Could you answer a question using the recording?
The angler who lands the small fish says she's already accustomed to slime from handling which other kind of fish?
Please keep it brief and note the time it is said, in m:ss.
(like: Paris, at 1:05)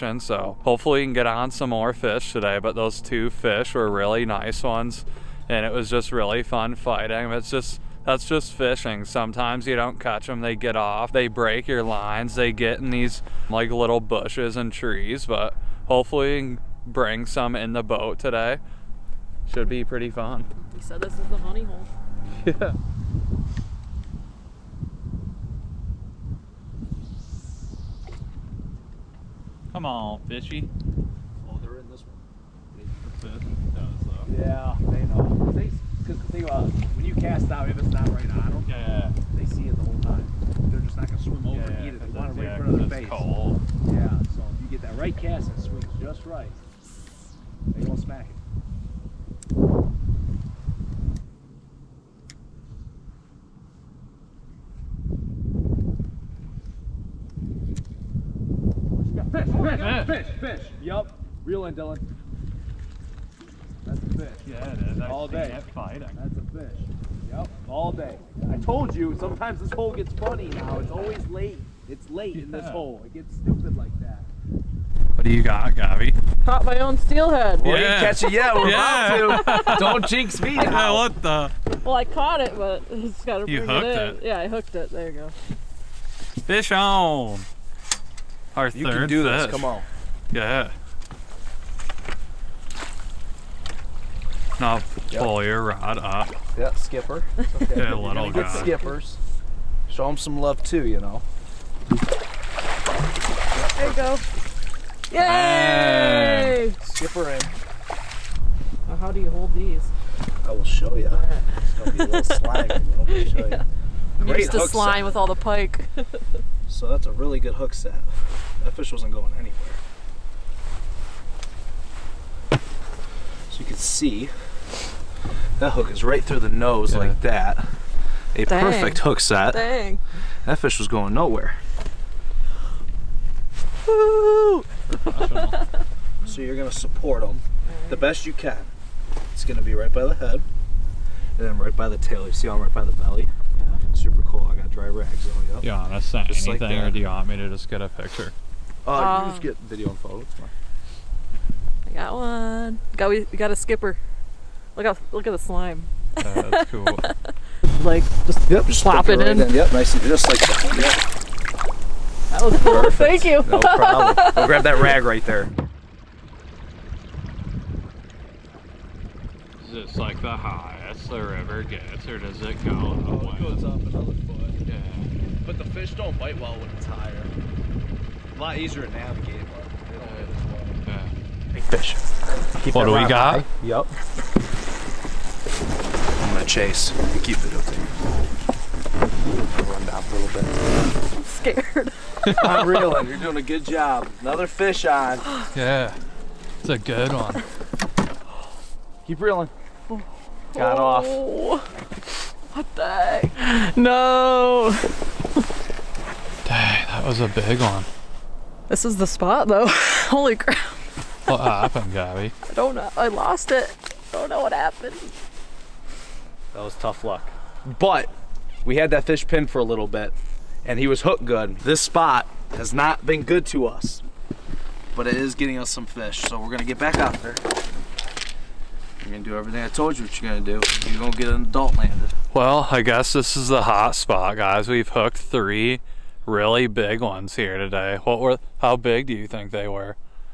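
pike, at 1:55.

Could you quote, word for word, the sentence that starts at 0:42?
They want it right in front of their face.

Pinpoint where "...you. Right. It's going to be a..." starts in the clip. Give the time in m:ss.
1:50.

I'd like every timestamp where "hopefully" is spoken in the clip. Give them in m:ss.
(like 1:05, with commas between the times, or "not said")
0:00, 0:15.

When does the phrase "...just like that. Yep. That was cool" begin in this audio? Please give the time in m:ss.
2:40.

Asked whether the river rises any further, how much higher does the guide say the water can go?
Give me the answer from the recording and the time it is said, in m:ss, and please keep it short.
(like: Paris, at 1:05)
1 foot, at 2:53.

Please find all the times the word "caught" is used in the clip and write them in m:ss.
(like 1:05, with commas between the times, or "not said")
1:16, 1:22.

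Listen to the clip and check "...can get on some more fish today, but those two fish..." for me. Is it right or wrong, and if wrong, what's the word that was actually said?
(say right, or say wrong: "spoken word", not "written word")
right.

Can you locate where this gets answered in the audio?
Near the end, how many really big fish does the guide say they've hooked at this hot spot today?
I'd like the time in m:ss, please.
3:55.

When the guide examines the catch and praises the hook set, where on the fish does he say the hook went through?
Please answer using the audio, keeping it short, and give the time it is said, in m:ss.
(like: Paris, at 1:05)
nose, at 2:06.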